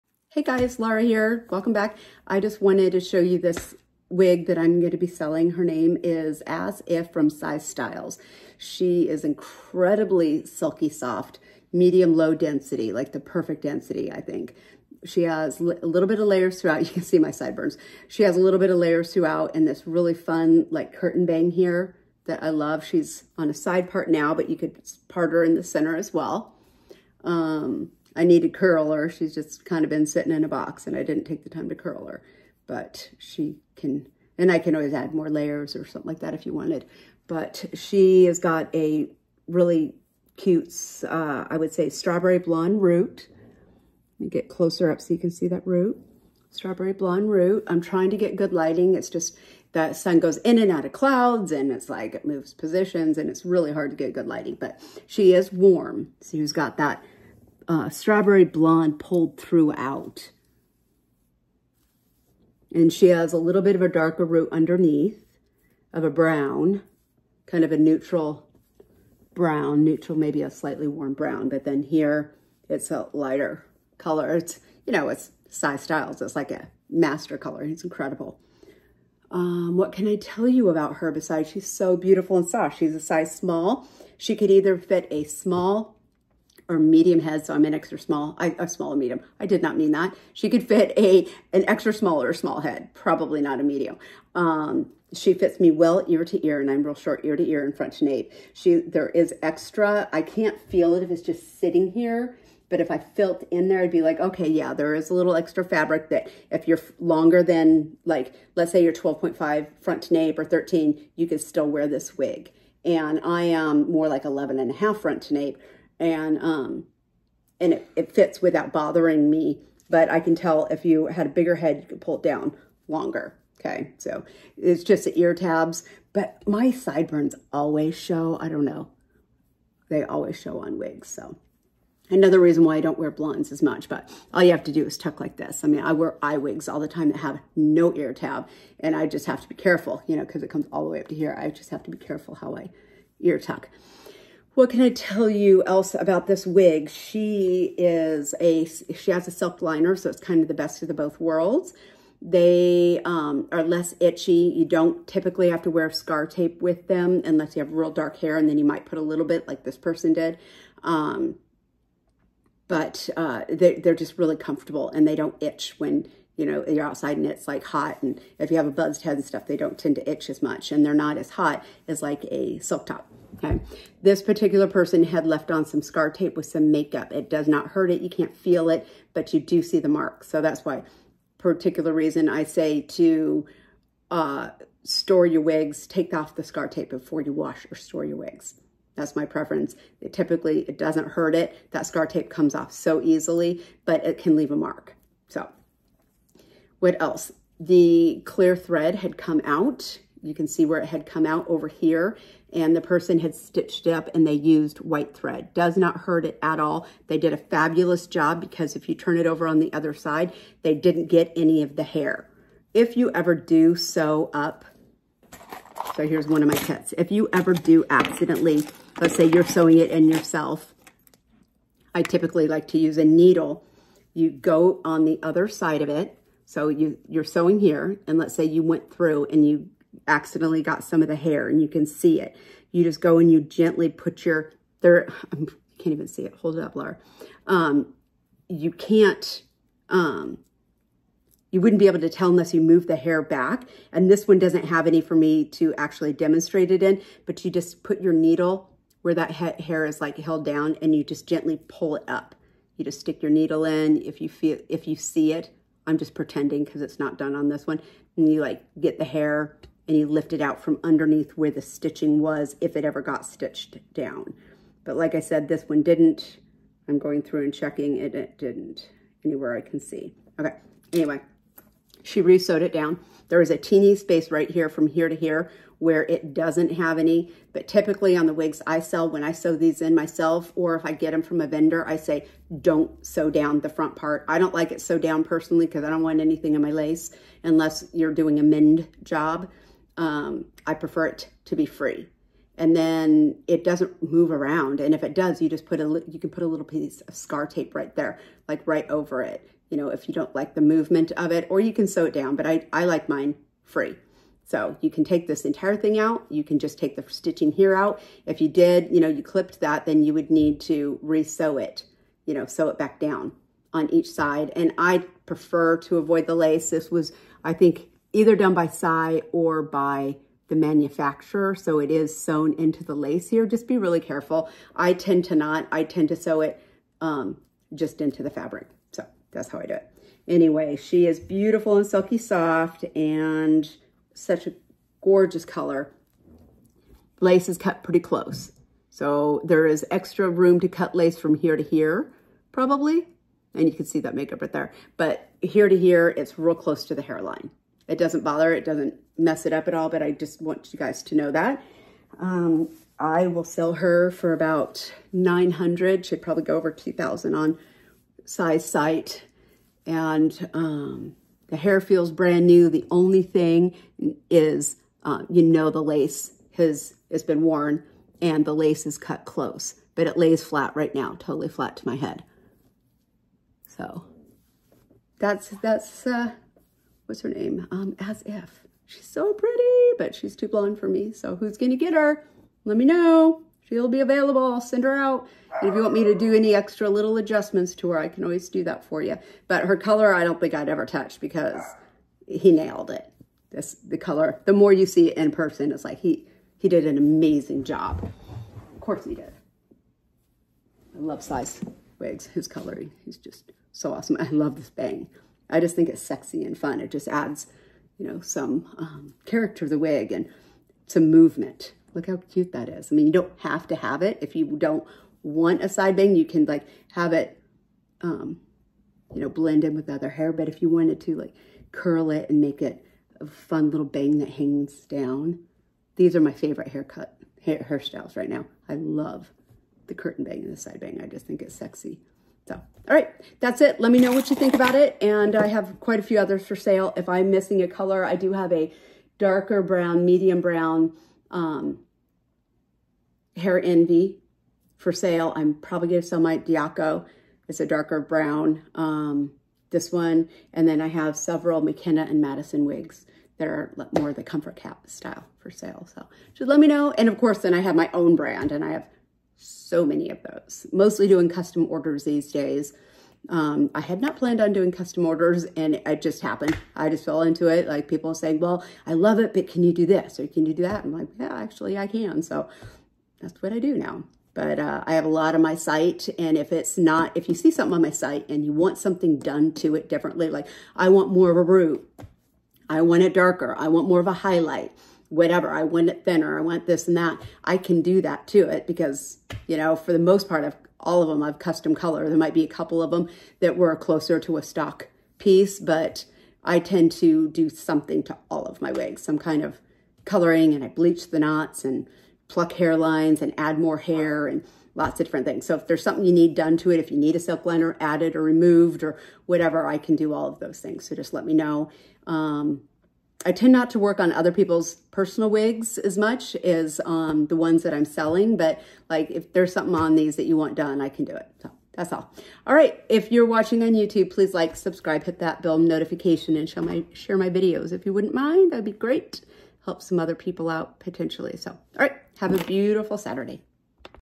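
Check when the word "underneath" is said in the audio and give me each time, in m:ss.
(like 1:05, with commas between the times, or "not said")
1:04, 4:20.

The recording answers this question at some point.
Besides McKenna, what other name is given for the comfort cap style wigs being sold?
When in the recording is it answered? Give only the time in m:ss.
7:32.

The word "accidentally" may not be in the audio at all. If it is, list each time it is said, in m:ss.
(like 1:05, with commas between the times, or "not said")
3:37, 3:50.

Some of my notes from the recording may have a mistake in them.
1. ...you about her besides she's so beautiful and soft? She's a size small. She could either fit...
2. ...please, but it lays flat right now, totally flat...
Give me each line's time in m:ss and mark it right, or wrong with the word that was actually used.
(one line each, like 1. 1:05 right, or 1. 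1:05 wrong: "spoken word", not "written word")
1. 1:20 right
2. 6:09 wrong: "close", not "please".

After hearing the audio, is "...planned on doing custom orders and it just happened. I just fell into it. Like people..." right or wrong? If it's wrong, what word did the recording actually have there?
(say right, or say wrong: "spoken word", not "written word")
right.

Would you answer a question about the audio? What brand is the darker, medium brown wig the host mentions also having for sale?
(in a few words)
Hair Envy.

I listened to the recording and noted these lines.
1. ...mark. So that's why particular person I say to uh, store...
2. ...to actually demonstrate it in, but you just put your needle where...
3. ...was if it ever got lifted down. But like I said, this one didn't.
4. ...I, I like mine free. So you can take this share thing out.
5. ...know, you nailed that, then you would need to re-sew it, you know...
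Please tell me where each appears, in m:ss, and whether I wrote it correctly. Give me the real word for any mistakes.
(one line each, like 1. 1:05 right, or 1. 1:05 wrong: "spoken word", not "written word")
1. 2:59 wrong: "reason", not "person"
2. 4:05 right
3. 4:22 wrong: "stitched", not "lifted"
4. 5:02 wrong: "entire", not "share"
5. 5:08 wrong: "clipped", not "nailed".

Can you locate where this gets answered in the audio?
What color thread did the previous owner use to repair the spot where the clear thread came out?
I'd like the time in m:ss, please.
3:24.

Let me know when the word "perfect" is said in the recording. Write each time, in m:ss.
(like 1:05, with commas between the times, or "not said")
0:13.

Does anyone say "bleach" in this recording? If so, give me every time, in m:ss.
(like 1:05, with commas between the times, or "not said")
8:20.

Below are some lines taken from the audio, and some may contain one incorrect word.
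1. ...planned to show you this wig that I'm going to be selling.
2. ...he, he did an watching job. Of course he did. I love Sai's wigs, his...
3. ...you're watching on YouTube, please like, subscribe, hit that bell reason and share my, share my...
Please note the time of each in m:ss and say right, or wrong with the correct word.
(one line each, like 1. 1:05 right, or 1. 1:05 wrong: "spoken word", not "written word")
1. 0:02 wrong: "wanted", not "planned"
2. 6:35 wrong: "amazing", not "watching"
3. 8:43 wrong: "notification", not "reason".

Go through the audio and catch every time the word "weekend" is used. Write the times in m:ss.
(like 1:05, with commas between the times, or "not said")
not said.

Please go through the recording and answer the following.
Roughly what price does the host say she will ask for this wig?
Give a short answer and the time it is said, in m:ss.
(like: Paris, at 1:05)
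About 900, at 5:54.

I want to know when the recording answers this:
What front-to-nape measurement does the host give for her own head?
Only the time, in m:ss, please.
1:54.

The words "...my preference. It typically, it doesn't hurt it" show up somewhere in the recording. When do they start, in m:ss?
3:09.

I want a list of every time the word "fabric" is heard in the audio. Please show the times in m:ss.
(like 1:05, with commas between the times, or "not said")
1:45, 5:28.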